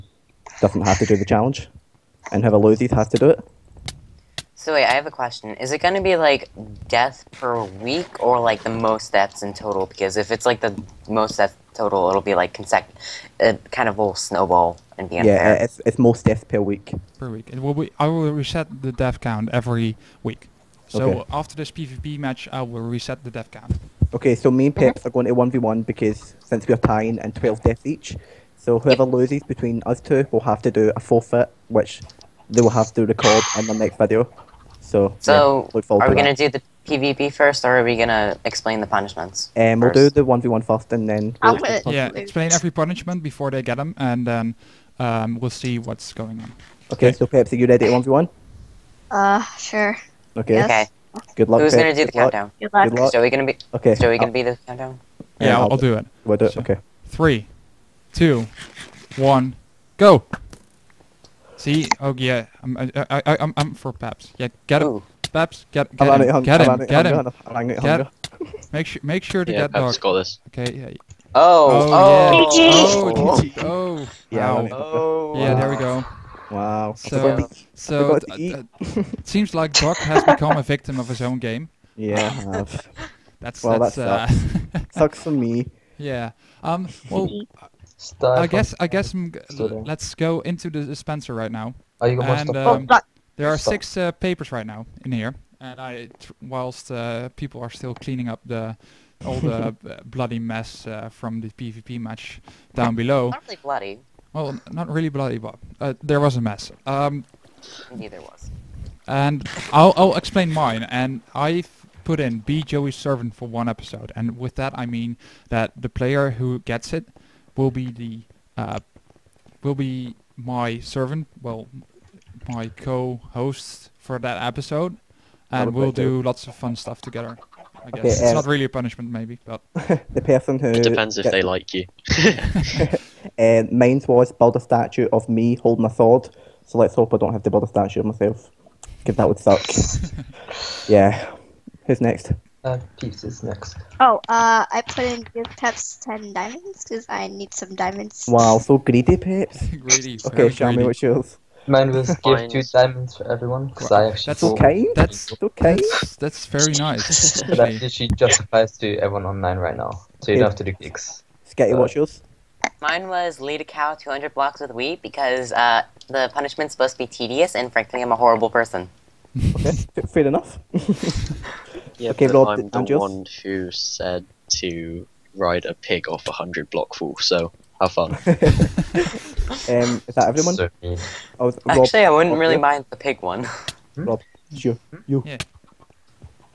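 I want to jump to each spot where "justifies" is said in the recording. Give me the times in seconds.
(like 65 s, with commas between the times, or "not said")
158 s.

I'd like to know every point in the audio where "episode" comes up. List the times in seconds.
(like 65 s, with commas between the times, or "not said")
113 s, 124 s.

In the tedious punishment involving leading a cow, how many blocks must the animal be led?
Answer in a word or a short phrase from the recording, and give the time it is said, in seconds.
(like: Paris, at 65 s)
200, at 163 s.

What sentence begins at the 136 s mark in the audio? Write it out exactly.
So let's hope I don't have to build a statue of myself, because that would suck.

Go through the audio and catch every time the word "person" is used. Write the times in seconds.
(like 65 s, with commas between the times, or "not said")
130 s, 168 s.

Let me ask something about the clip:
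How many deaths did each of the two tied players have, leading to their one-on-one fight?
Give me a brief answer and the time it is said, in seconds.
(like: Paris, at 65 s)
12, at 27 s.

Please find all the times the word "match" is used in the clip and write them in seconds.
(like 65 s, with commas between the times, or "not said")
22 s, 102 s.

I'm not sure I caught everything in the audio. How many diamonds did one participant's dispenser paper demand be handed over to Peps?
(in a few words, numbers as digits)
10.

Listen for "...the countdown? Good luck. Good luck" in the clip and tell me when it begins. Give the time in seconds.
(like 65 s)
52 s.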